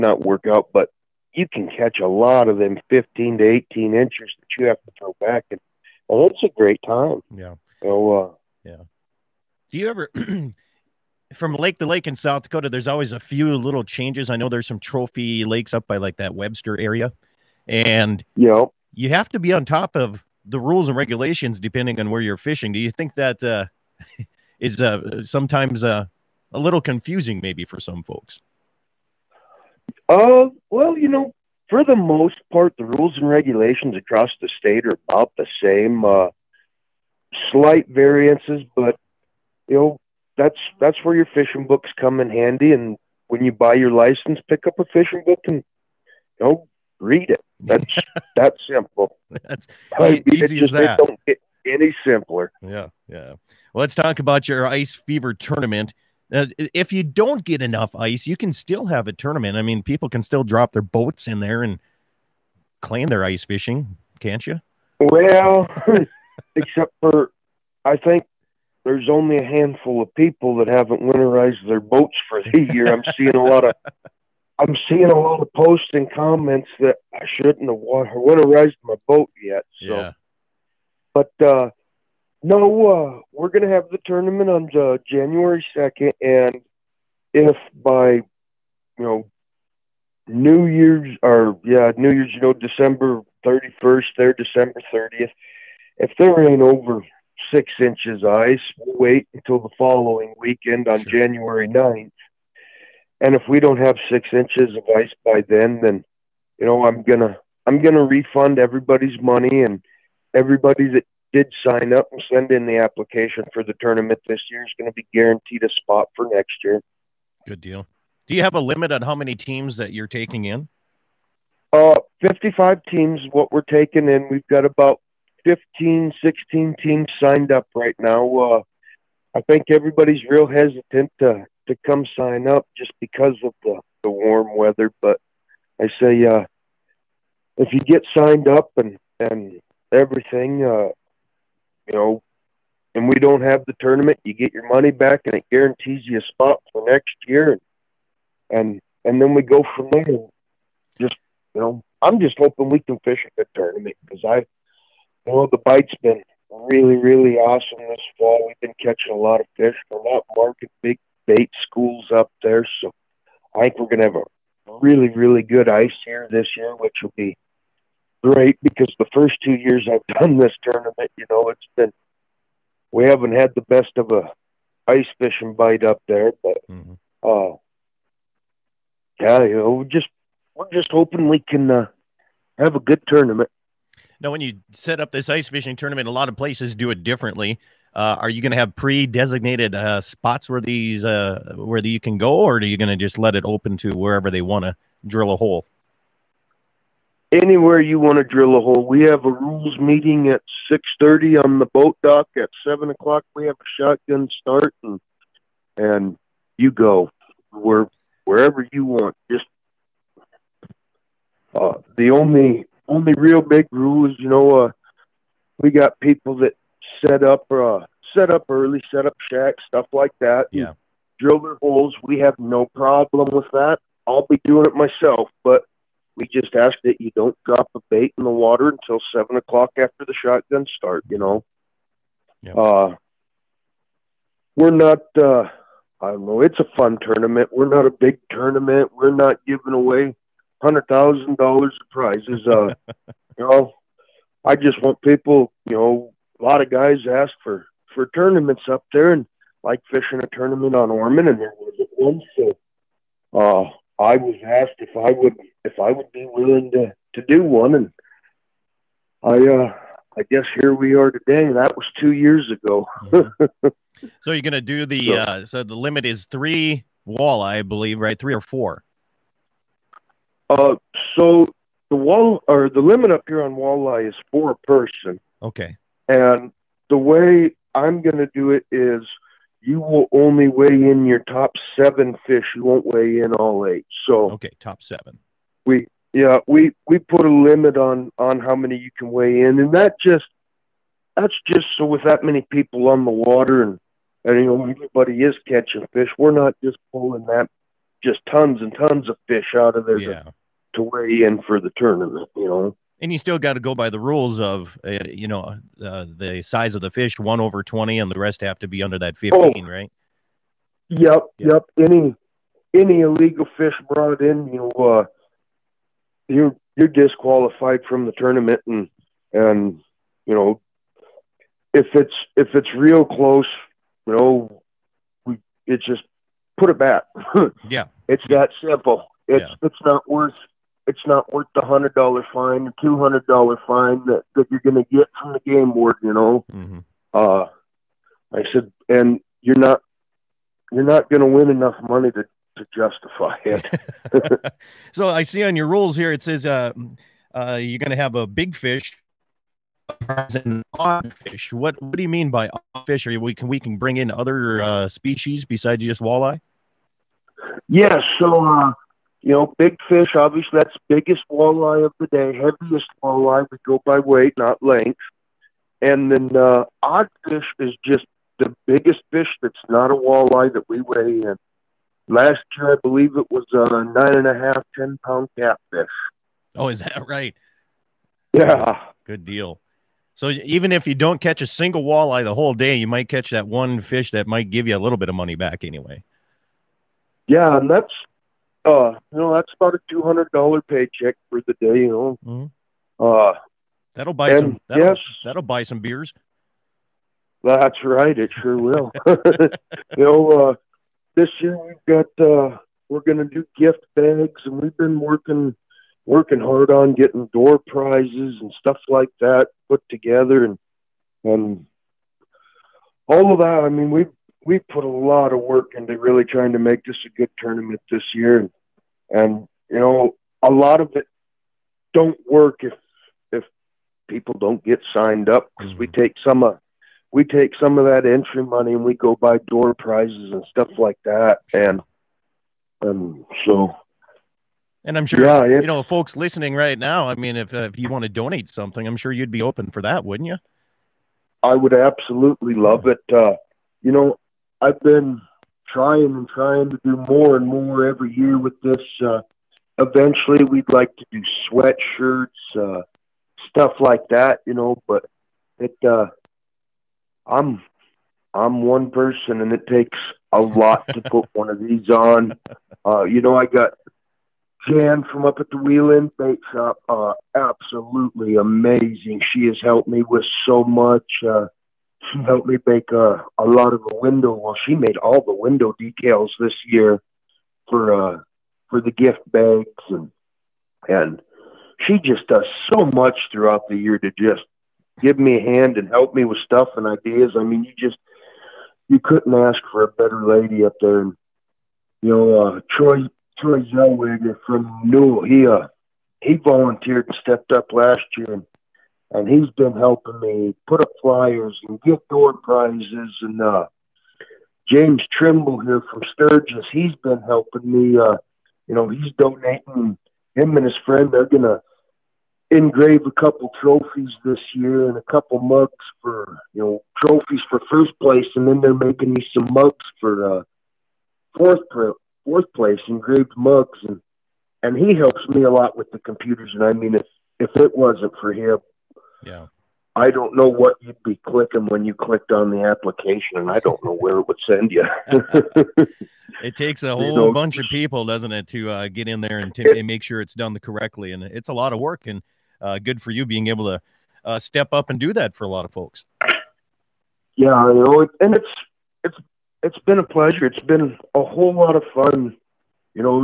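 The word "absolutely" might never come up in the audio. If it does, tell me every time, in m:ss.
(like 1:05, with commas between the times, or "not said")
7:21, 7:47.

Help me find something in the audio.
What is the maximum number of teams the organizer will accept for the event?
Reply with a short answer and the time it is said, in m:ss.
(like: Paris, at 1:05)
55, at 2:02.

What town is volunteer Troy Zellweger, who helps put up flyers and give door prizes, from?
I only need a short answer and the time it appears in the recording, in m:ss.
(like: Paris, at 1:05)
Newell, at 8:14.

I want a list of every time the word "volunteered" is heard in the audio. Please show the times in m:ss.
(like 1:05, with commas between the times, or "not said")
8:16.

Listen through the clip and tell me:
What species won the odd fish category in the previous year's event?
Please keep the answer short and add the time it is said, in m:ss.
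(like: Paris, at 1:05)
catfish, at 6:15.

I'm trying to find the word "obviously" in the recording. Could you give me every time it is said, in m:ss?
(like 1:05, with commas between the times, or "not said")
6:00.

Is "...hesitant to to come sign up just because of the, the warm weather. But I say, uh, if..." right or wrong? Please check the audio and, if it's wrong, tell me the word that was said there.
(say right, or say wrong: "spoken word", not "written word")
right.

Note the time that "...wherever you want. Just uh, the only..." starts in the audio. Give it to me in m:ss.
3:28.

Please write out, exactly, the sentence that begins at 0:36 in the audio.
Uh, slight variances, but you know that's that's where your fishing books come in handy.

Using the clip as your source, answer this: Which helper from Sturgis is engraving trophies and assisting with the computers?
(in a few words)
James Trimble.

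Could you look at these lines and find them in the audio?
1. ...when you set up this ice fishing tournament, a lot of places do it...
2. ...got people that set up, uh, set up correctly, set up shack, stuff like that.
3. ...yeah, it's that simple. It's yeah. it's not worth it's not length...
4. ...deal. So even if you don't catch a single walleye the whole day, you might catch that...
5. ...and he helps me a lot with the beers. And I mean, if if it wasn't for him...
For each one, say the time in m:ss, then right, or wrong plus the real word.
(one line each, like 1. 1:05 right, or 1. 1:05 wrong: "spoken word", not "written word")
1. 3:04 right
2. 3:35 wrong: "early", not "correctly"
3. 5:27 wrong: "worth", not "length"
4. 6:19 right
5. 8:44 wrong: "computers", not "beers".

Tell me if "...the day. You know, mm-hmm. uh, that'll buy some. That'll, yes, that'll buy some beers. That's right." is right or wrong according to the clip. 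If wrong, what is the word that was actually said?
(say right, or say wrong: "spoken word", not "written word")
right.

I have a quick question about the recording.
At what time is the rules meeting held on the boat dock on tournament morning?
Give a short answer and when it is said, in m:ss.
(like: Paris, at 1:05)
6:30, at 3:20.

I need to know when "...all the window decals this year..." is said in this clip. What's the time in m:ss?
7:54.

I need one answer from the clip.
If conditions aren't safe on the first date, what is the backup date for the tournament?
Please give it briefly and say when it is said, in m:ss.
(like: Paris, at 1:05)
January 9, at 1:41.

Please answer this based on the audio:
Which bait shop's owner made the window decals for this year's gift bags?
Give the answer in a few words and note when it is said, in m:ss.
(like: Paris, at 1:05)
Wheel End Bait Shop, at 7:45.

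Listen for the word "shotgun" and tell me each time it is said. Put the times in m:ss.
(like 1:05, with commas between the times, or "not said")
3:23, 3:50.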